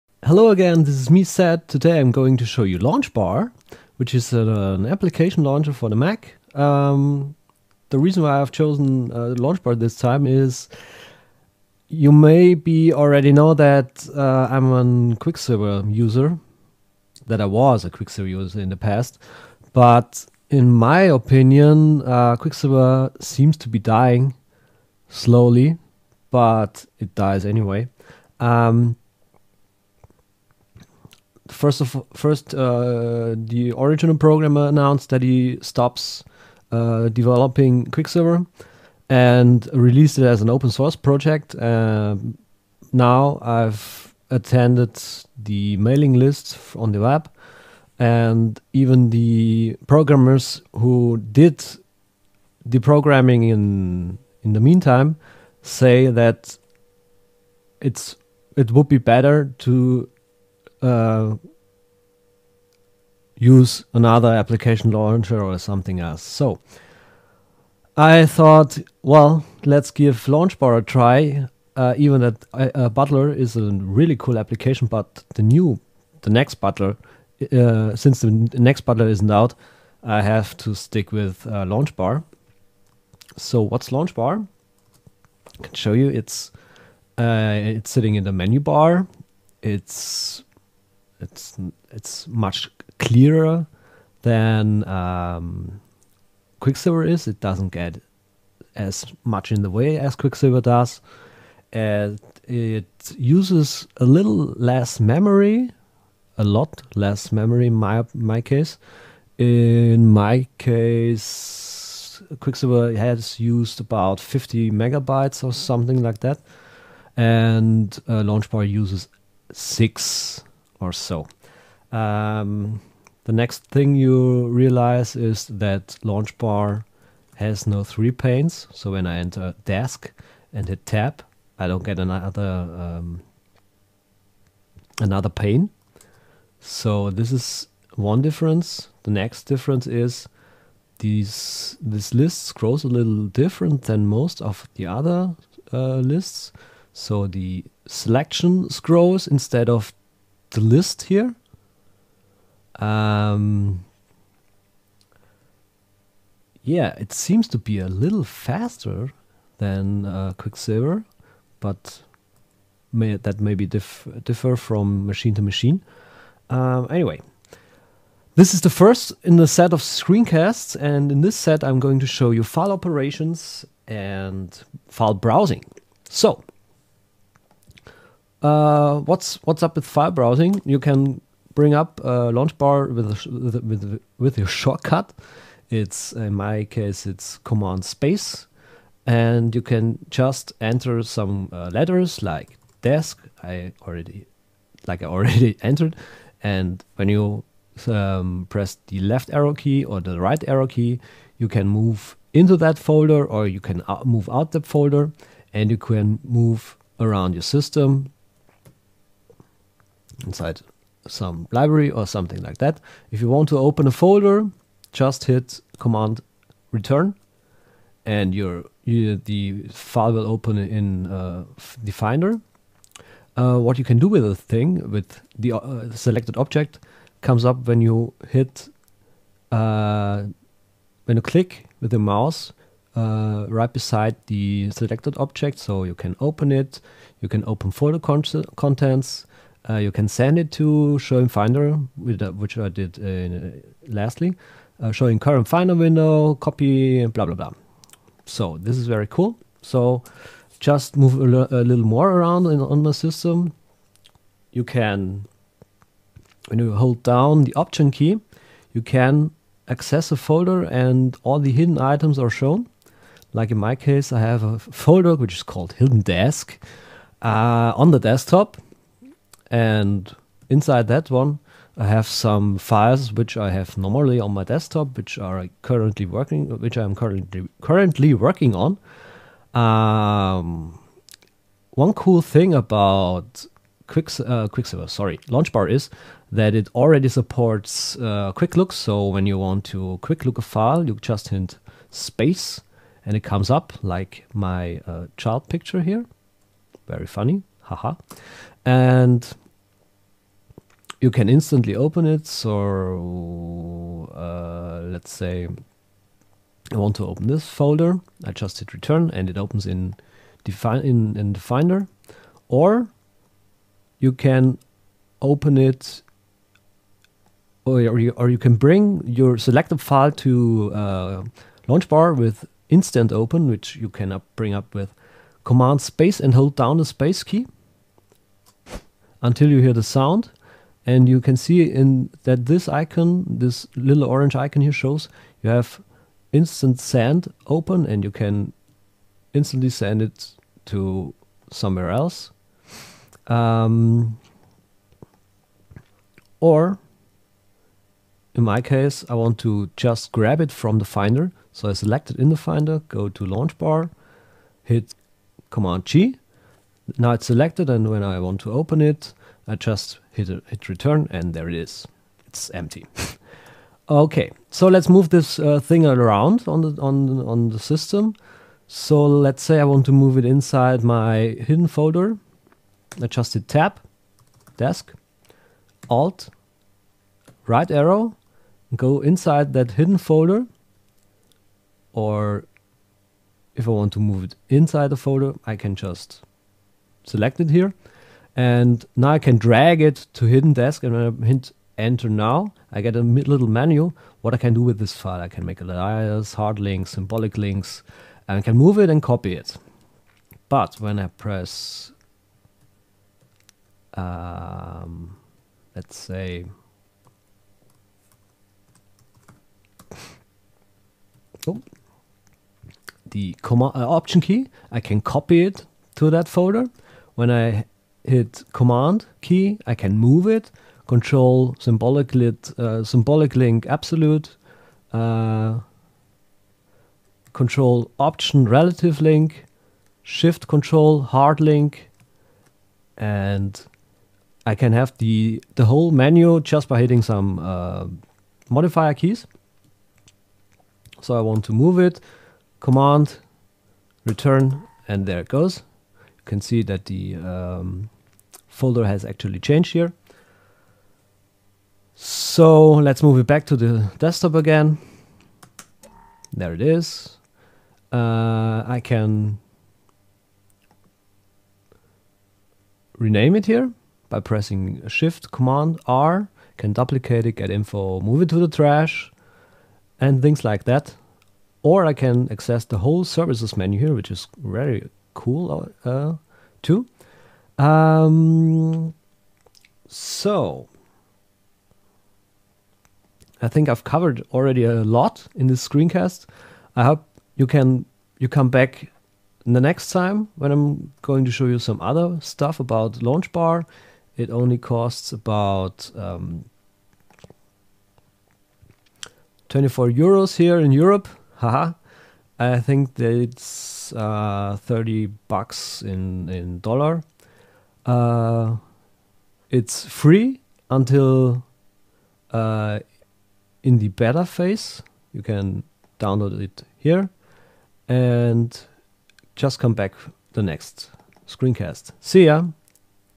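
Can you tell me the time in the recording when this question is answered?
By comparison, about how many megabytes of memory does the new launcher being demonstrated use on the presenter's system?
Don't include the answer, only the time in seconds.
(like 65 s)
119 s.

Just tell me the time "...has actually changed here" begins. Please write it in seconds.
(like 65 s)
448 s.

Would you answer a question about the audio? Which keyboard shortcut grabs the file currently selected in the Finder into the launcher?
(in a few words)
Command G.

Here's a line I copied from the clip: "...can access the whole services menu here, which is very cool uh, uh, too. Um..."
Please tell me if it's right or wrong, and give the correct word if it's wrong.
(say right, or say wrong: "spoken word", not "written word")
right.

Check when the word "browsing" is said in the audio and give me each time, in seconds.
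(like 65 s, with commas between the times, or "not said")
175 s, 180 s.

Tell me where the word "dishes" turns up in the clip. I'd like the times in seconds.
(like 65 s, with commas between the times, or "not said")
not said.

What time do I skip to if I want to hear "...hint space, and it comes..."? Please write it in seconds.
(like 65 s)
291 s.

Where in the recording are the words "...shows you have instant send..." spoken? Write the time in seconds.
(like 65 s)
334 s.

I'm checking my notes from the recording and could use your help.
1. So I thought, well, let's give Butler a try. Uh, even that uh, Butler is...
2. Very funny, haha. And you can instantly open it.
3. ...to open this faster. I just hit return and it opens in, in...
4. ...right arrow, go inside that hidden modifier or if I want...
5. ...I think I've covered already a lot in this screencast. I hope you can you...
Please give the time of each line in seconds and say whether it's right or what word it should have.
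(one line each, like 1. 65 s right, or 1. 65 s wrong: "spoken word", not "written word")
1. 66 s wrong: "LaunchBar", not "Butler"
2. 296 s right
3. 306 s wrong: "folder", not "faster"
4. 377 s wrong: "folder", not "modifier"
5. 483 s right.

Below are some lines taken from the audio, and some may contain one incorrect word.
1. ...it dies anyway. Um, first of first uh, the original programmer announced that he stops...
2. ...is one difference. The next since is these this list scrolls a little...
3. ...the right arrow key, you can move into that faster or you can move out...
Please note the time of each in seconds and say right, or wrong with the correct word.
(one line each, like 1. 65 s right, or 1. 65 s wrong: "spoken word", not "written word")
1. 26 s right
2. 137 s wrong: "difference", not "since"
3. 200 s wrong: "folder", not "faster".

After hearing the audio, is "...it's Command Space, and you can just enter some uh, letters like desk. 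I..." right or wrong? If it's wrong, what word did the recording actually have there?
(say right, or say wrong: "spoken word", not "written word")
right.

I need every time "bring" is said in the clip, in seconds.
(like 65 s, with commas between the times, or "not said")
181 s, 318 s, 324 s.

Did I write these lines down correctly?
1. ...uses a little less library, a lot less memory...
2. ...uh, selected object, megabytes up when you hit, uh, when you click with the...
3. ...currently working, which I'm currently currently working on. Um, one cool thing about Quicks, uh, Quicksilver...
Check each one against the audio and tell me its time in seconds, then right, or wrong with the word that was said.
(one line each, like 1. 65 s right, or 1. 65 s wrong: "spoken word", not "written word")
1. 103 s wrong: "memory", not "library"
2. 225 s wrong: "comes", not "megabytes"
3. 275 s right.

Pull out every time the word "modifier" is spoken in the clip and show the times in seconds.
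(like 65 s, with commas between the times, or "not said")
438 s.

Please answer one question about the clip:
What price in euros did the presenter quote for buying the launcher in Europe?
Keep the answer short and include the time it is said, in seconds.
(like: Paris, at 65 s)
24 euros, at 499 s.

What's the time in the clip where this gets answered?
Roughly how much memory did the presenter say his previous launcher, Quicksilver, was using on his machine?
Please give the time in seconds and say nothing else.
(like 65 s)
114 s.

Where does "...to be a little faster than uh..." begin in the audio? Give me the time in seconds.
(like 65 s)
157 s.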